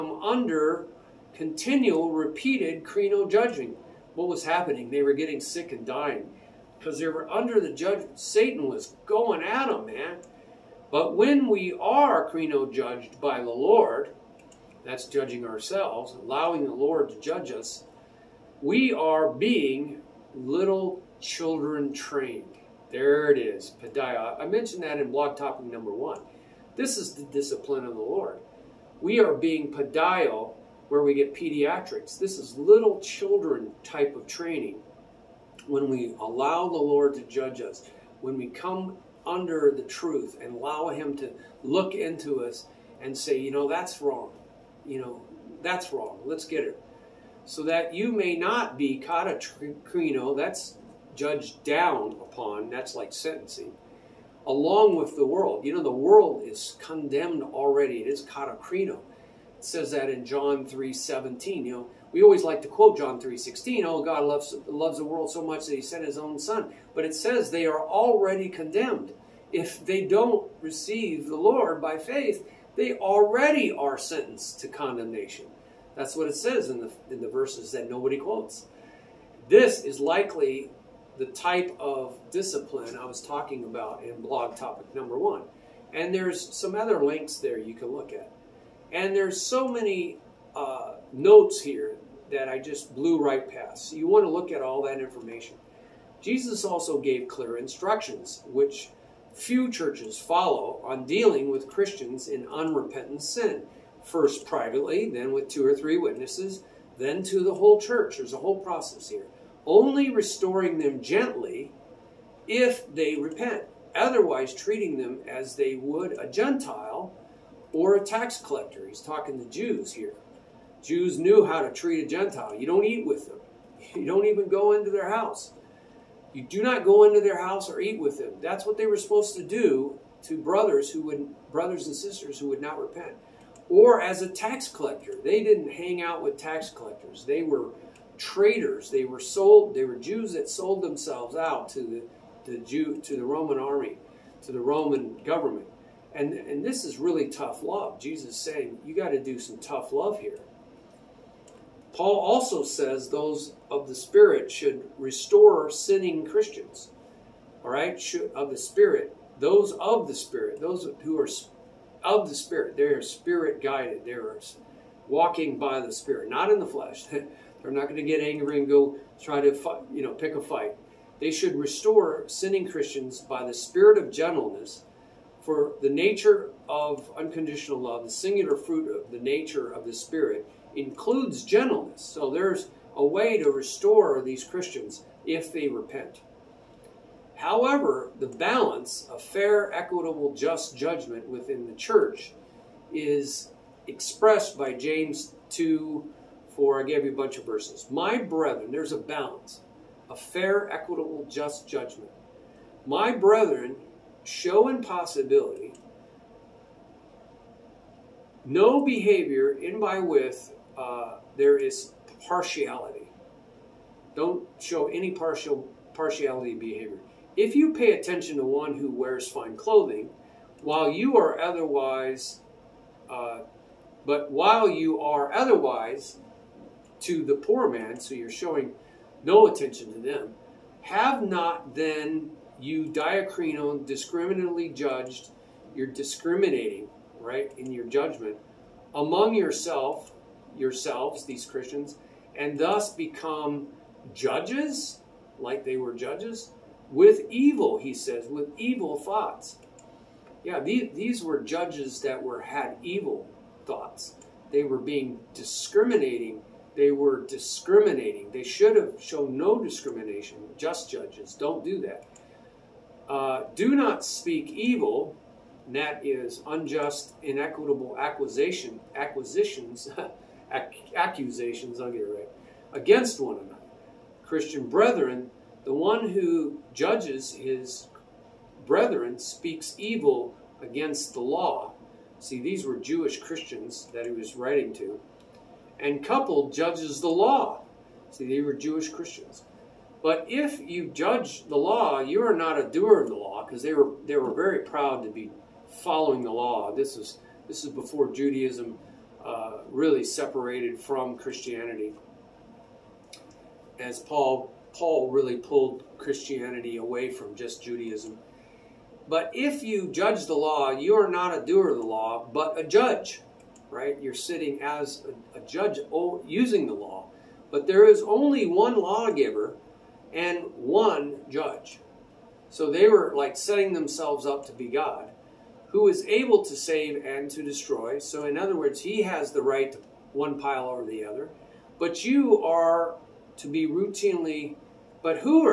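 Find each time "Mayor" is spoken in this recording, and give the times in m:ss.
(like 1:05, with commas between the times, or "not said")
not said.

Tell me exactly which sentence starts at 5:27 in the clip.
So, in other words, he has the right to one pile or the other.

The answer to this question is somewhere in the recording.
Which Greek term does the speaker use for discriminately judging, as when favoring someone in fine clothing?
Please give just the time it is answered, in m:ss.
3:52.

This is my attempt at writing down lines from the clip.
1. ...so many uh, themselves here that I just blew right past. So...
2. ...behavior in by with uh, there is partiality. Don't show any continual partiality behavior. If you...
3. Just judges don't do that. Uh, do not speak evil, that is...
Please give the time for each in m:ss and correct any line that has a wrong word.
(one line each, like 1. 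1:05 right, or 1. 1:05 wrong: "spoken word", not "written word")
1. 1:29 wrong: "notes", not "themselves"
2. 3:28 wrong: "partial", not "continual"
3. 4:20 right.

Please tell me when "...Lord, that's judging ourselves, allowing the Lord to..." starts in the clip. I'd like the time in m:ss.
0:13.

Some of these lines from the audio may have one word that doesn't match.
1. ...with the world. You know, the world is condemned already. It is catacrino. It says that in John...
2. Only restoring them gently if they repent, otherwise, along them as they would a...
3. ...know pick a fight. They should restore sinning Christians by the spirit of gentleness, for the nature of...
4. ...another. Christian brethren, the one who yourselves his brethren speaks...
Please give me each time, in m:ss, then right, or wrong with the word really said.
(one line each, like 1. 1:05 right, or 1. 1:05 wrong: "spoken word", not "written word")
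1. 0:54 right
2. 1:49 wrong: "treating", not "along"
3. 2:50 right
4. 4:33 wrong: "judges", not "yourselves".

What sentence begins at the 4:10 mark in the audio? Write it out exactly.
Yeah, these, these were judges that were had evil thoughts.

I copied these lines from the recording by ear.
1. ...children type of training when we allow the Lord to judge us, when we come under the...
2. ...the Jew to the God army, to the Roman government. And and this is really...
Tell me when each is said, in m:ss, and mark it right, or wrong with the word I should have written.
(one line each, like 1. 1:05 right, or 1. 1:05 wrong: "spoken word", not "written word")
1. 0:32 right
2. 2:22 wrong: "Roman", not "God".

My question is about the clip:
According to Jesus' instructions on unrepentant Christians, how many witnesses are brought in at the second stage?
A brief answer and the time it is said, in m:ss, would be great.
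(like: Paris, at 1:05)
2 or 3, at 1:45.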